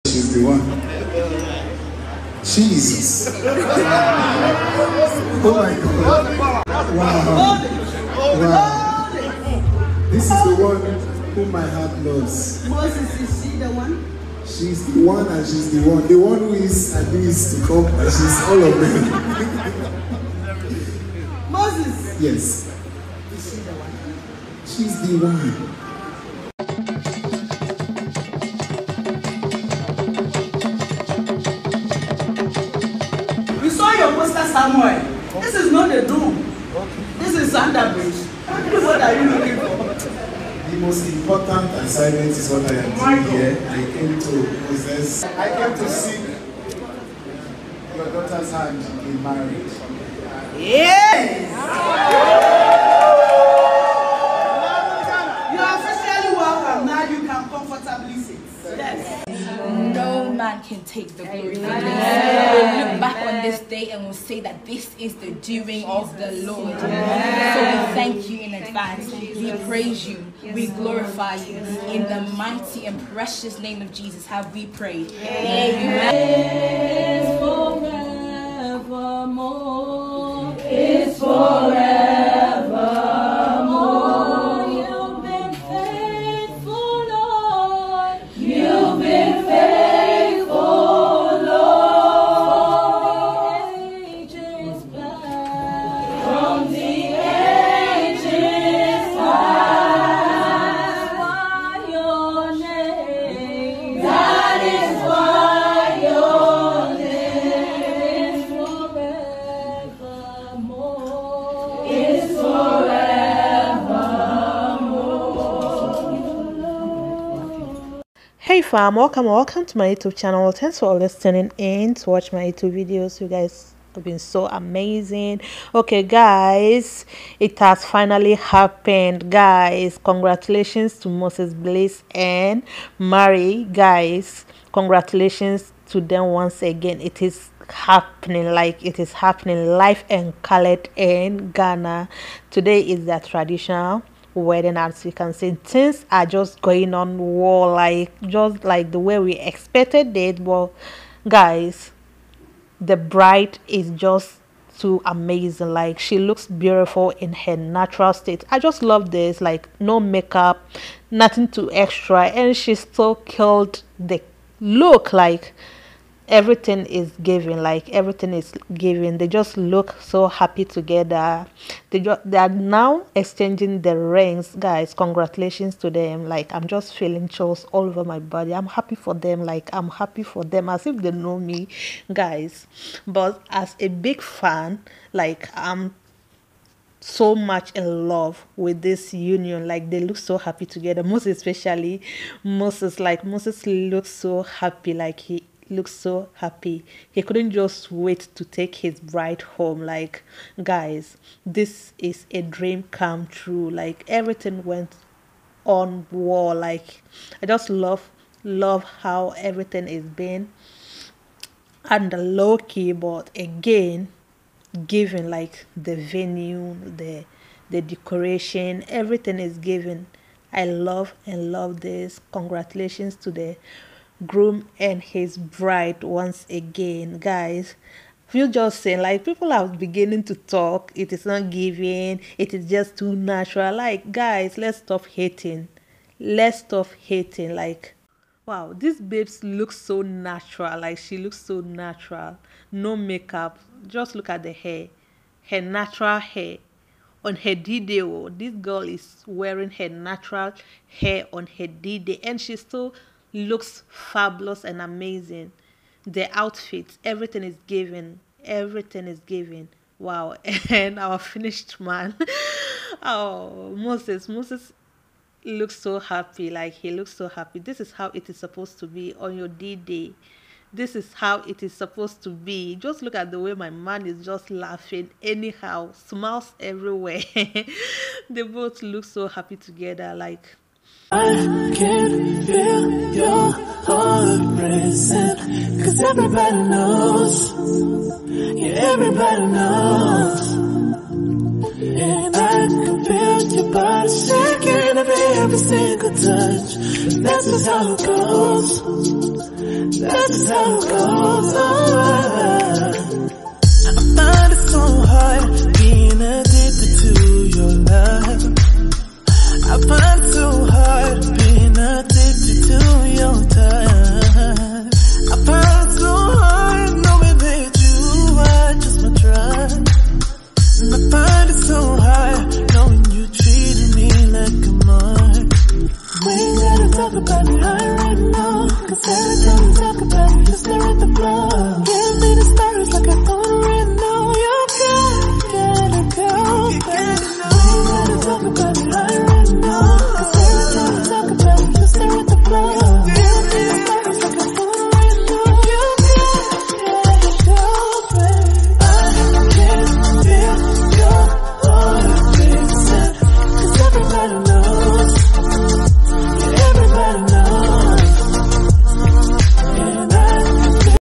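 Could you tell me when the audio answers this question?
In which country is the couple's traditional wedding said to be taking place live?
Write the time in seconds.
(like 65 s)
141 s.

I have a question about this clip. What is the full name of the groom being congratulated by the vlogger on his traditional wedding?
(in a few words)
Moses Bliss.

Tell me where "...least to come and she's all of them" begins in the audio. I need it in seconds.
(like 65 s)
17 s.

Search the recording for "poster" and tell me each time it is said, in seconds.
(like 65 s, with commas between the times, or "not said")
34 s.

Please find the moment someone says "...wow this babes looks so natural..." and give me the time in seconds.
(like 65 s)
238 s.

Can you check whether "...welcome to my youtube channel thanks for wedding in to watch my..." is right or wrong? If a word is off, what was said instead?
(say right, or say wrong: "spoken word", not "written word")
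wrong: "listening", not "wedding".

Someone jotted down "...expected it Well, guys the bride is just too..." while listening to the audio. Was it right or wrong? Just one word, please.
right.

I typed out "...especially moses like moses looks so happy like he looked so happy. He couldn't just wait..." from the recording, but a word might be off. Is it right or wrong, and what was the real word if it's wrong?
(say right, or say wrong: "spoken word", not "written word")
right.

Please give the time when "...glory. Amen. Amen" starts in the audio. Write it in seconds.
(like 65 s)
61 s.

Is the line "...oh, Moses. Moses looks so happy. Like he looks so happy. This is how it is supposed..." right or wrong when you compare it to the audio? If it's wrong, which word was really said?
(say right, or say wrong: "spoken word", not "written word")
right.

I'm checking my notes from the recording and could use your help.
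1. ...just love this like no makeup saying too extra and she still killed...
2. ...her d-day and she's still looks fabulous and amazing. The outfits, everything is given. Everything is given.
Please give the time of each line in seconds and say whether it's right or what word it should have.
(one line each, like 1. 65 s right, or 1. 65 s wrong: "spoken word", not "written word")
1. 158 s wrong: "nothing", not "saying"
2. 251 s right.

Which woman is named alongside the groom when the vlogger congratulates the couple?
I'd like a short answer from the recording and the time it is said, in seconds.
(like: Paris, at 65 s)
Mary, at 132 s.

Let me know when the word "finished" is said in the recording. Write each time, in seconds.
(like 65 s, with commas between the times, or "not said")
261 s.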